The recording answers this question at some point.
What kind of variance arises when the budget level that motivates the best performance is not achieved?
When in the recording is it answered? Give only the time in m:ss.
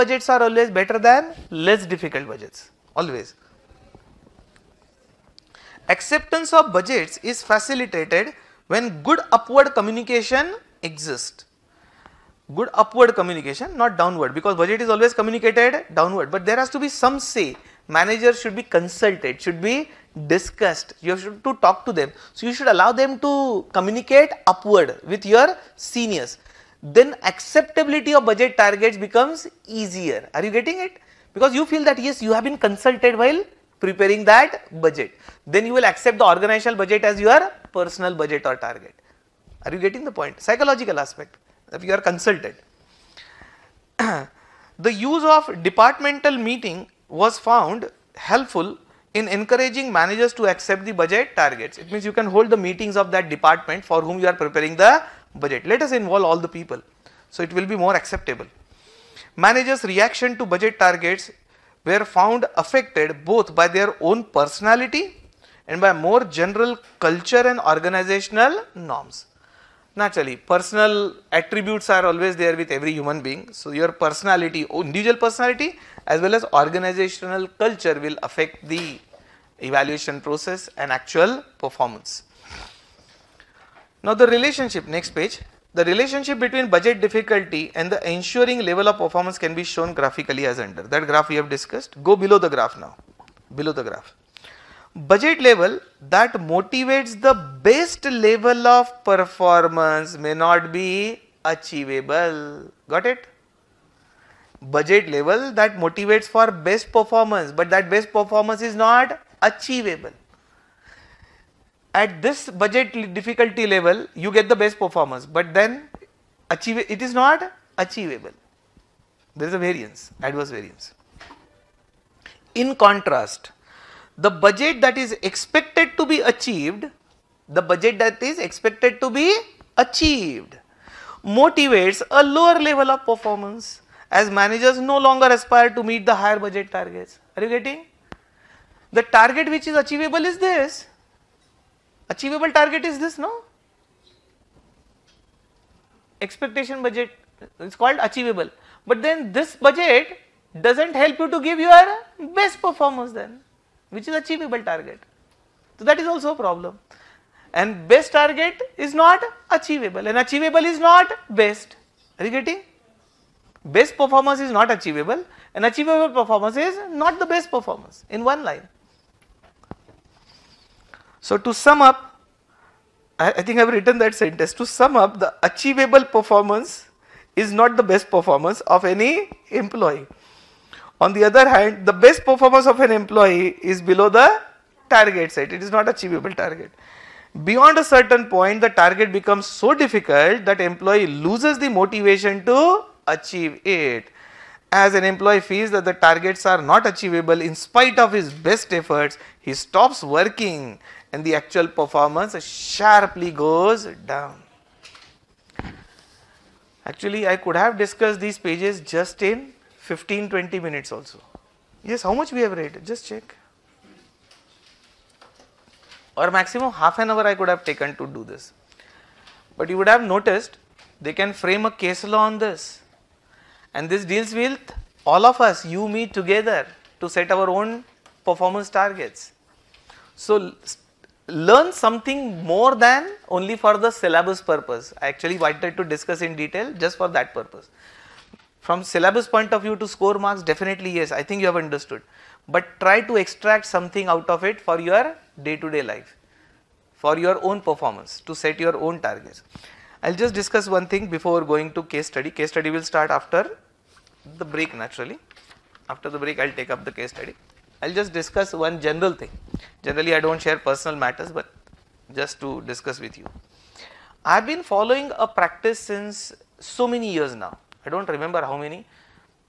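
2:00.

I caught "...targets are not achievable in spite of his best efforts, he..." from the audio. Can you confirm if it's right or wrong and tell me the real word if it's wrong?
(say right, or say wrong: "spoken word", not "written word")
right.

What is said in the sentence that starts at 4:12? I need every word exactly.
Case study will start after the break naturally.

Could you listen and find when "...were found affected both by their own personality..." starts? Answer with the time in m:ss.
1:01.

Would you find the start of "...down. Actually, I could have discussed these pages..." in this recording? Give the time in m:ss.
3:24.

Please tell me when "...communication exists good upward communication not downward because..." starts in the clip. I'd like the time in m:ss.
0:09.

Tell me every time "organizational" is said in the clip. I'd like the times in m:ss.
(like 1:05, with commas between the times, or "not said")
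0:36, 1:07, 1:16.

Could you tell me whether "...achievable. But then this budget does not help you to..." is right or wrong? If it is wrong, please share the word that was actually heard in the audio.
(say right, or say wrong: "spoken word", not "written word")
right.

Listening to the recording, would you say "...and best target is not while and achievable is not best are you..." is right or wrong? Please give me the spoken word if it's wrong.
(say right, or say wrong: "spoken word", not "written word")
wrong: "achievable", not "while".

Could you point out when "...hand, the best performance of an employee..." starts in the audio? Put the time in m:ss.
3:01.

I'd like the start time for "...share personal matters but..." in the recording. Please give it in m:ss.
4:20.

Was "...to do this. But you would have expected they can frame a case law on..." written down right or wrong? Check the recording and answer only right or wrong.
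wrong.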